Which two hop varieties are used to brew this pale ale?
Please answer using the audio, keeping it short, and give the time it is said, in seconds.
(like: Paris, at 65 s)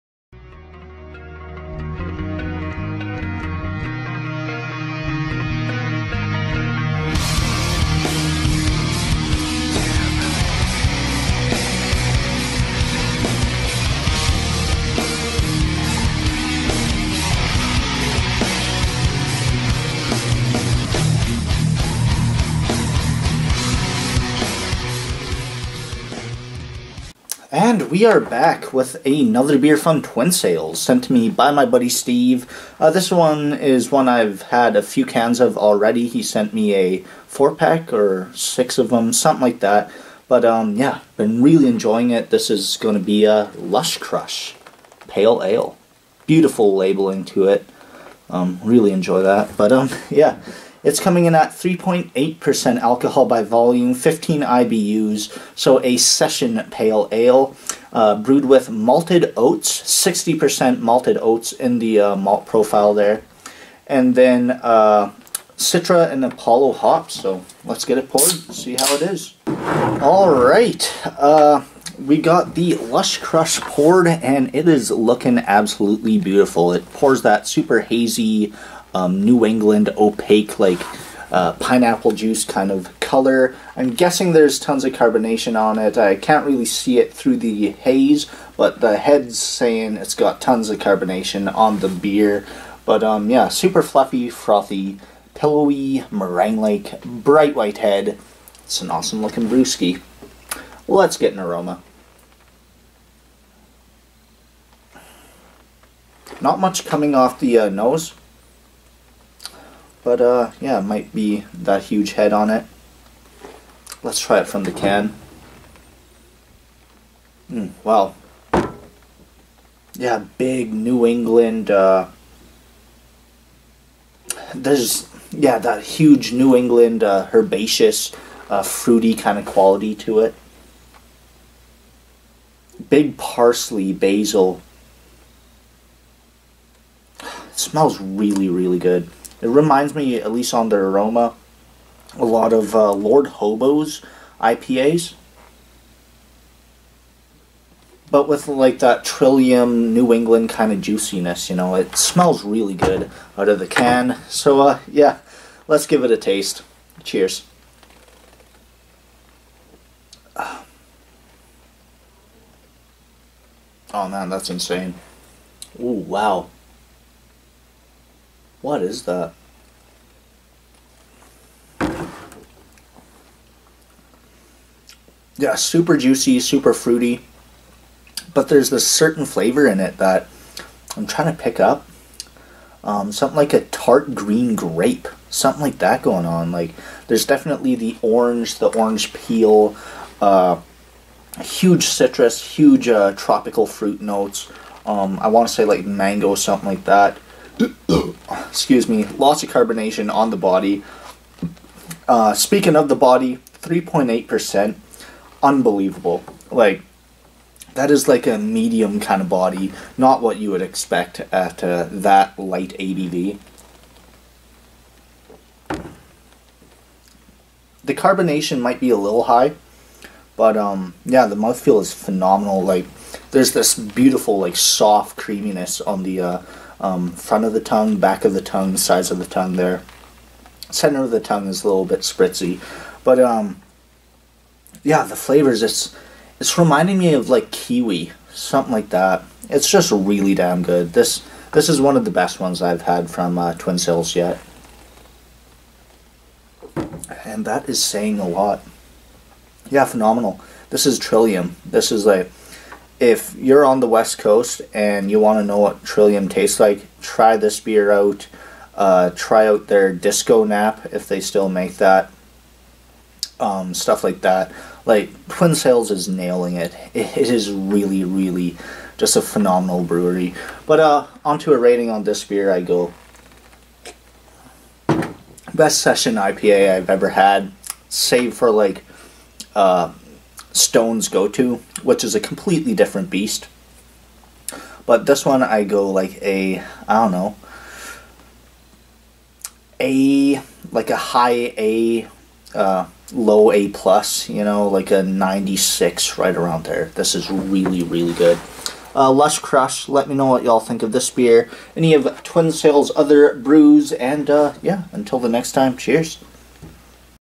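Citra and Apollo, at 65 s.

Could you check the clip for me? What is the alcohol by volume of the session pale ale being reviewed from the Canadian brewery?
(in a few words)
3.8%.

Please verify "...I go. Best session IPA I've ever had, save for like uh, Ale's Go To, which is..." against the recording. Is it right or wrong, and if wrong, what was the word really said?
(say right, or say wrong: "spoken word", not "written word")
wrong: "Stone", not "Ale".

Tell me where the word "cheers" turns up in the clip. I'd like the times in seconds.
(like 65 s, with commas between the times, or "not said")
157 s, 305 s.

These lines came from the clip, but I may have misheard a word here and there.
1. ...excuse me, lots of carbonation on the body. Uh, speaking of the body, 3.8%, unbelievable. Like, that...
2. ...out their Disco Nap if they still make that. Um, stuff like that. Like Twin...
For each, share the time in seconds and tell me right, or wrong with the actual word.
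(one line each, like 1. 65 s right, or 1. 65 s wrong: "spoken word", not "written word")
1. 198 s right
2. 259 s right.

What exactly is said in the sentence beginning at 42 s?
This is going to be a Lush Crush Pale Ale.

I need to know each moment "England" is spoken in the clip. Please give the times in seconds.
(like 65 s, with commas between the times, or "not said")
79 s, 121 s, 126 s, 150 s.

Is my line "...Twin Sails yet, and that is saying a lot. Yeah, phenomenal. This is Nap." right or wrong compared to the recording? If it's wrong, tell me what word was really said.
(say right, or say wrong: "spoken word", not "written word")
wrong: "Trillium", not "Nap".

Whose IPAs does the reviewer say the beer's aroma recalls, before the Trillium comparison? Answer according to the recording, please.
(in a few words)
Lord Hobo.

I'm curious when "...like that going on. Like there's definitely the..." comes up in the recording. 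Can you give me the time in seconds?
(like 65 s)
185 s.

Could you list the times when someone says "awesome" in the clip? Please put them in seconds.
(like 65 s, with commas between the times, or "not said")
98 s.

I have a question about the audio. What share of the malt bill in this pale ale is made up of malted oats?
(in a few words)
60%.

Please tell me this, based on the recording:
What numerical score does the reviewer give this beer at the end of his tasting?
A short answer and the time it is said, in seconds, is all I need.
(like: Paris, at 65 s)
96, at 295 s.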